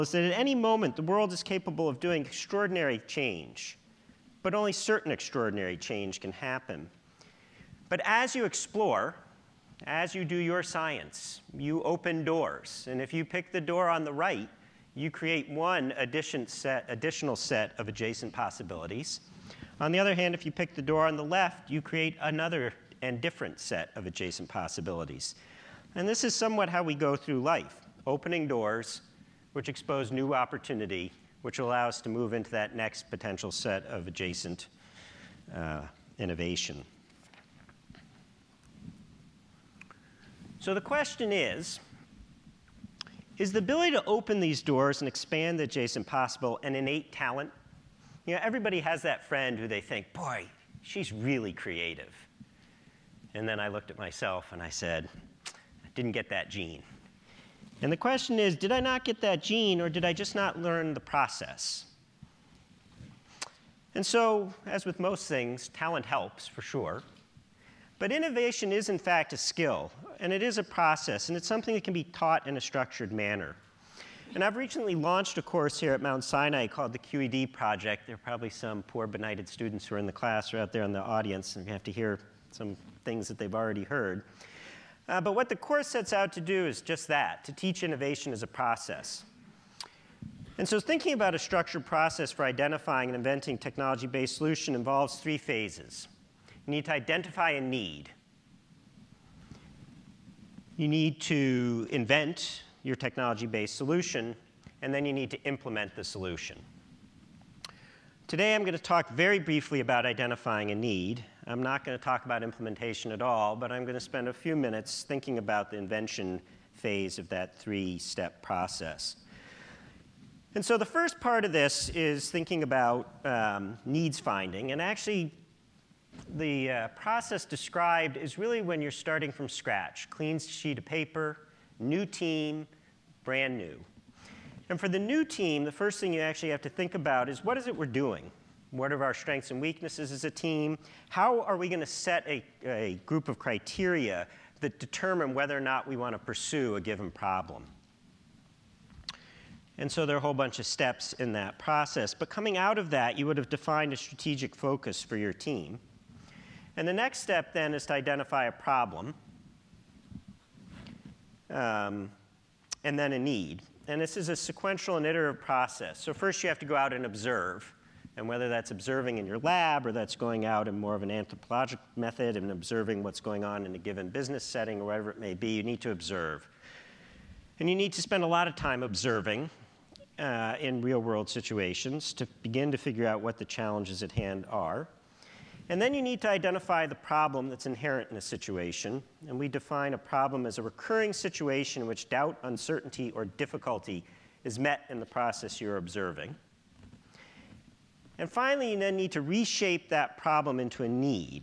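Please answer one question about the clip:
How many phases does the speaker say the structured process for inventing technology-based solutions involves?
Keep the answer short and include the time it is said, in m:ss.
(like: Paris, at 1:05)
3, at 1:35.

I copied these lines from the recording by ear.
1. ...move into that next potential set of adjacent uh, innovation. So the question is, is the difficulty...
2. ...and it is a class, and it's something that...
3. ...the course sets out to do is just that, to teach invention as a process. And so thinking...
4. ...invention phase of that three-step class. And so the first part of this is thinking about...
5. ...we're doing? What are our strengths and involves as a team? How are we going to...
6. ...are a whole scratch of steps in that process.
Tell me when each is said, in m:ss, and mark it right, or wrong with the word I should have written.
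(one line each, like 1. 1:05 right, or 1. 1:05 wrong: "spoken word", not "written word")
1. 0:32 wrong: "ability", not "difficulty"
2. 1:10 wrong: "process", not "class"
3. 1:25 wrong: "innovation", not "invention"
4. 1:55 wrong: "process", not "class"
5. 2:17 wrong: "weaknesses", not "involves"
6. 2:30 wrong: "bunch", not "scratch".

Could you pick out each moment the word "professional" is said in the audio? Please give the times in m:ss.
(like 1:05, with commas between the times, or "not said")
not said.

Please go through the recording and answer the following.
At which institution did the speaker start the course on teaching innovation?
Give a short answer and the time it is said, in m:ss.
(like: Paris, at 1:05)
Mount Sinai, at 1:16.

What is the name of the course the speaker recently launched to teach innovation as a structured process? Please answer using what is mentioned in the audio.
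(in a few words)
QED Project.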